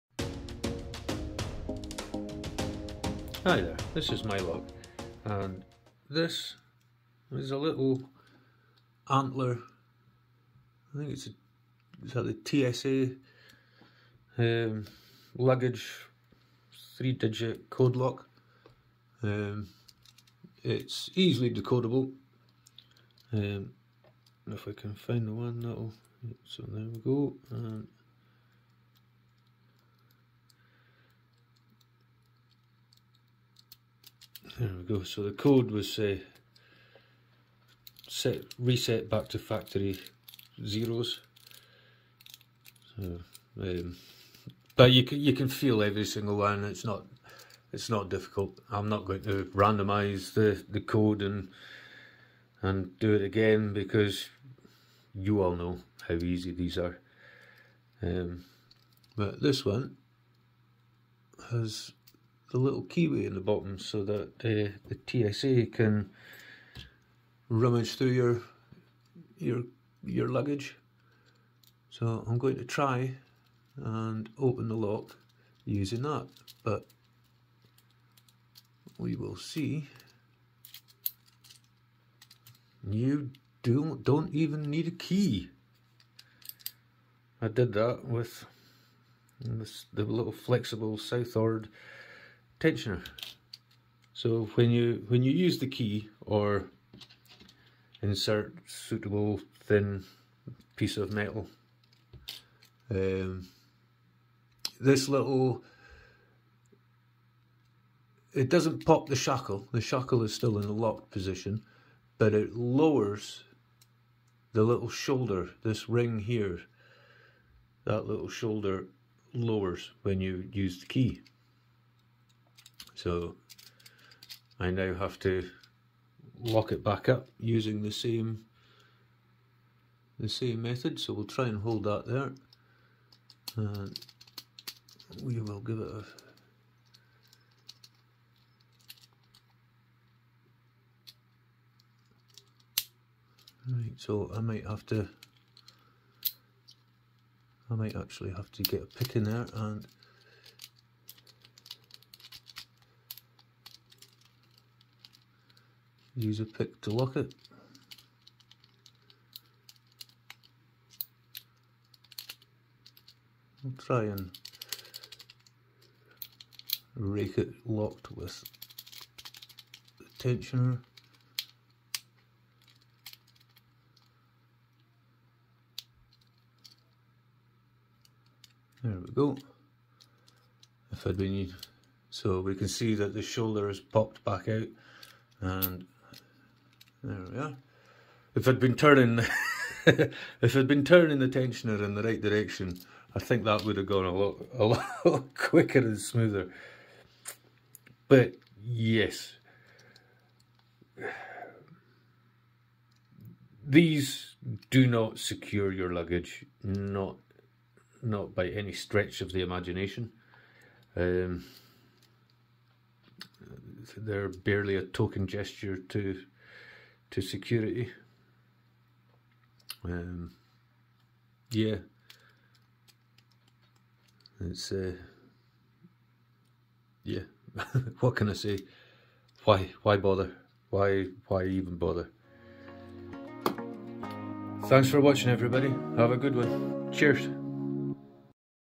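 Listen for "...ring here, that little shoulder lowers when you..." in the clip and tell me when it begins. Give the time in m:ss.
1:55.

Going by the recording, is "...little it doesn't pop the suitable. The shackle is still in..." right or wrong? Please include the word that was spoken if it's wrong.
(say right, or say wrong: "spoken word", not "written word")
wrong: "shackle", not "suitable".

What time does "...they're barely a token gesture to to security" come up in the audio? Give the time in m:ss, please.
3:33.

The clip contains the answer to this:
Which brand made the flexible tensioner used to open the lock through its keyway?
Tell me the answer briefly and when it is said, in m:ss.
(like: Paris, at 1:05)
SouthOrd, at 1:30.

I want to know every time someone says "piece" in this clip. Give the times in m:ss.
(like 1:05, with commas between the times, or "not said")
1:40.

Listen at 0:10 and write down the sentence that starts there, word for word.
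I think it's a, is that the TSA um, luggage three digit code lock.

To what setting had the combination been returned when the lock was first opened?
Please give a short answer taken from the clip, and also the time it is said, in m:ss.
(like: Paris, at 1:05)
factory zeros, at 0:39.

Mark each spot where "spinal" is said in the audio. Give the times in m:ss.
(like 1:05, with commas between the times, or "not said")
not said.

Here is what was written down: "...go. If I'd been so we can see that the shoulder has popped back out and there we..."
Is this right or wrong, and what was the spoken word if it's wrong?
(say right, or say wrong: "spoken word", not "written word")
right.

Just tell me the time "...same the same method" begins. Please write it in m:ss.
2:07.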